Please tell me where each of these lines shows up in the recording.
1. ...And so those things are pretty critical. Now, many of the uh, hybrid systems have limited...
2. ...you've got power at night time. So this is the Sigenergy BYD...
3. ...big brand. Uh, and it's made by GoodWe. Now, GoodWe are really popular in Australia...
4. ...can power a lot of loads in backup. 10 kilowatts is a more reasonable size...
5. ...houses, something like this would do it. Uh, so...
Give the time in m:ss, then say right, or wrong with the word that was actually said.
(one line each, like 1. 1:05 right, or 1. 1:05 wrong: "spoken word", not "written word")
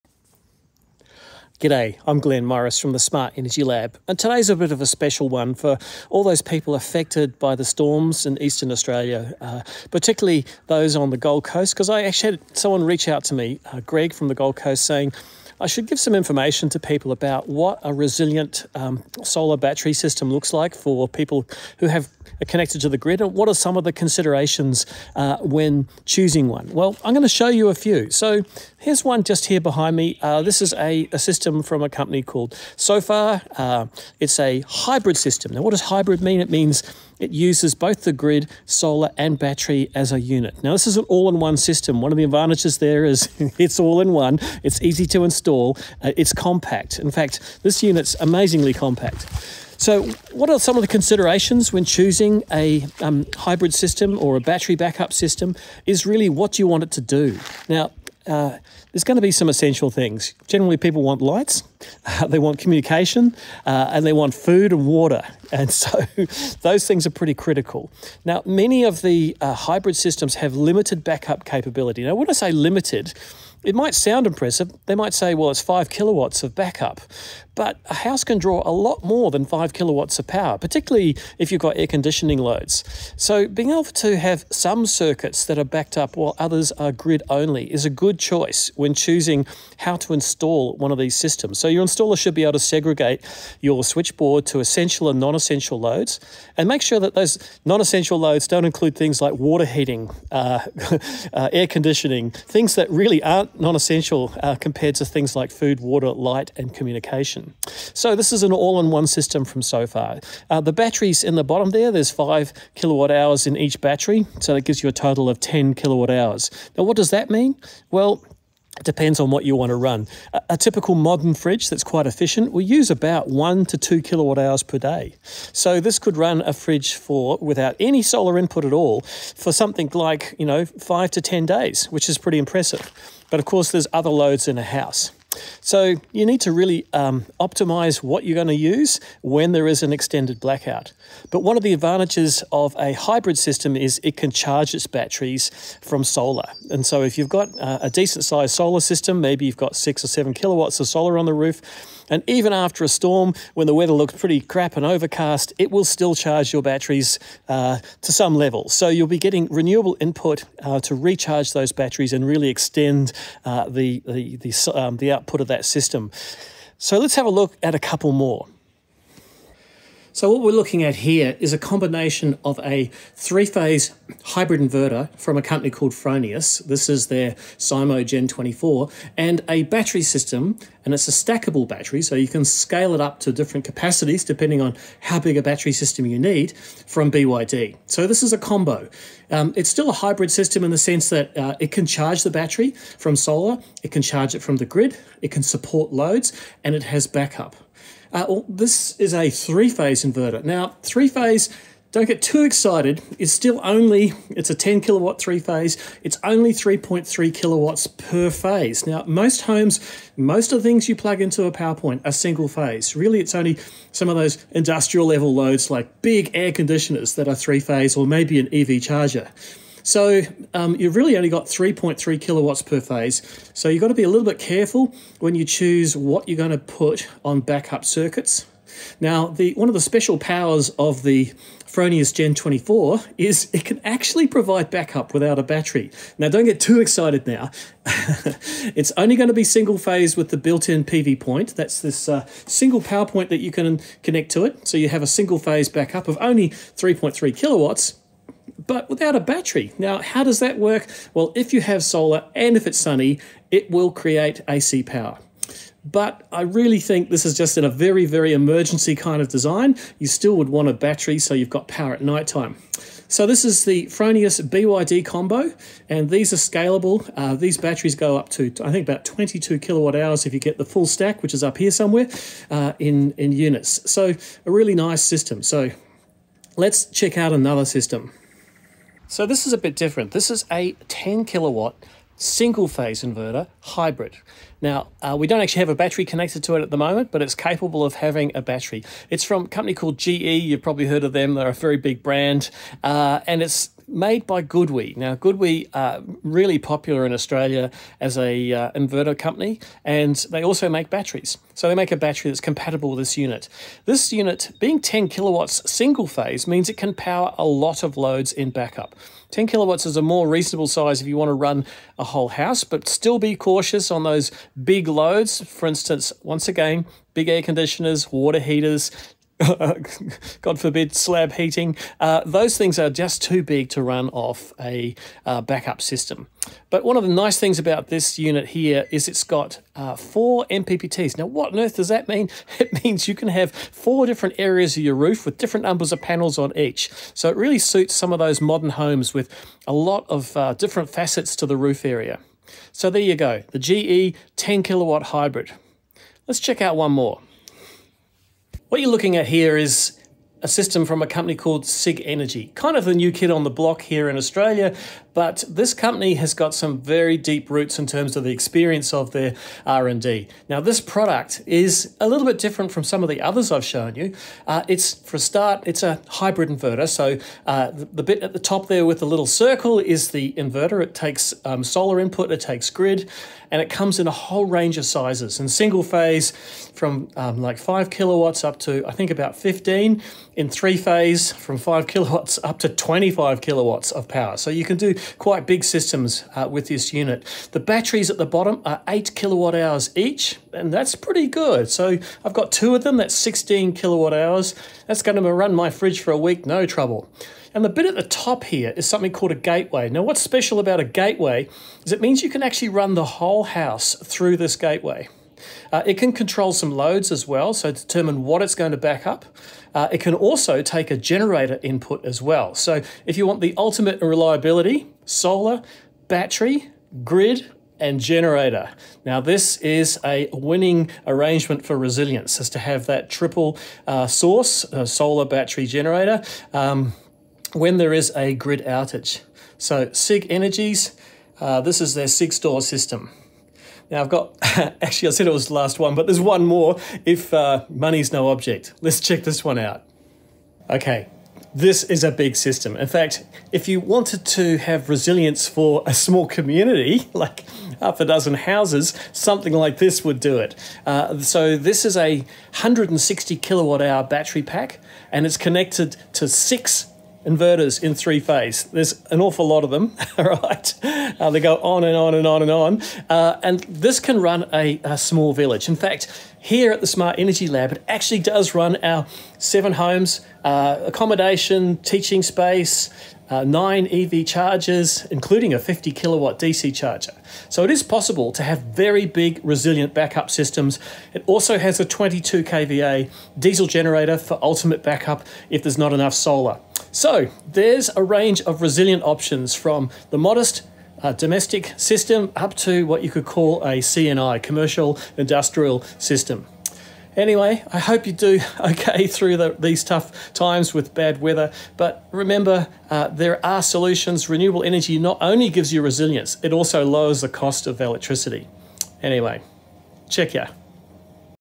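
1. 1:05 right
2. 4:21 wrong: "Fronius", not "Sigenergy"
3. 4:51 right
4. 5:06 right
5. 7:28 right.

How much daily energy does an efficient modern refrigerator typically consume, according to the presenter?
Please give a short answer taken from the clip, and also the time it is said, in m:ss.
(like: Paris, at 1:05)
1 to 2 kilowatt hours, at 2:03.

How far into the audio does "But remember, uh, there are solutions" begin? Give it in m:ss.
8:21.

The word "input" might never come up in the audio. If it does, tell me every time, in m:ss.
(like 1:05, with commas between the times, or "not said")
2:08, 2:40, 6:11, 6:51.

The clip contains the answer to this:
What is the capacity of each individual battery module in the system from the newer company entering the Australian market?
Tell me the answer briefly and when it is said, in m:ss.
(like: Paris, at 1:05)
8 kilowatt hours, at 6:28.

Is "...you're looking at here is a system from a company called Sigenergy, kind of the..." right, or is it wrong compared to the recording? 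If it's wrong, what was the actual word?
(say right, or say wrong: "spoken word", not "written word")
right.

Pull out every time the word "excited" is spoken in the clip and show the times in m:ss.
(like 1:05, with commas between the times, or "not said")
3:22, 3:56.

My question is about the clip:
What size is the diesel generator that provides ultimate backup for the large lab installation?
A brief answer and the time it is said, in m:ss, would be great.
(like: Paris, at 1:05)
22 kVA, at 8:01.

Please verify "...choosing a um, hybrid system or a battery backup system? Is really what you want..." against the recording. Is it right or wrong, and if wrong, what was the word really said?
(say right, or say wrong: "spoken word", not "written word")
right.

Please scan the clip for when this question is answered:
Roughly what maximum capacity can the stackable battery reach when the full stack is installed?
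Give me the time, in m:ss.
4:29.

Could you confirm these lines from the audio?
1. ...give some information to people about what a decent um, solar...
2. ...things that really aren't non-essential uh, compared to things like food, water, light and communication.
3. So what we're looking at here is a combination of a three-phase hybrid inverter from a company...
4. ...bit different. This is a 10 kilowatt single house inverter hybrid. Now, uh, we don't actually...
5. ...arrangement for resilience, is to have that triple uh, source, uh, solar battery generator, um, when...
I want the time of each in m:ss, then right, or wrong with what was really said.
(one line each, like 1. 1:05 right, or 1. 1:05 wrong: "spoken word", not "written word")
1. 0:15 wrong: "resilient", not "decent"
2. 1:42 right
3. 2:50 right
4. 4:39 wrong: "phase", not "house"
5. 7:01 right.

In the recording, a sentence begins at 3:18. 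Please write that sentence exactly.
Uh, well, this is a three-phase inverter.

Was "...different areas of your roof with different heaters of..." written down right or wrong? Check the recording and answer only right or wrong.
wrong.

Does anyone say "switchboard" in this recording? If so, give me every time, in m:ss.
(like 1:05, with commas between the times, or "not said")
1:33.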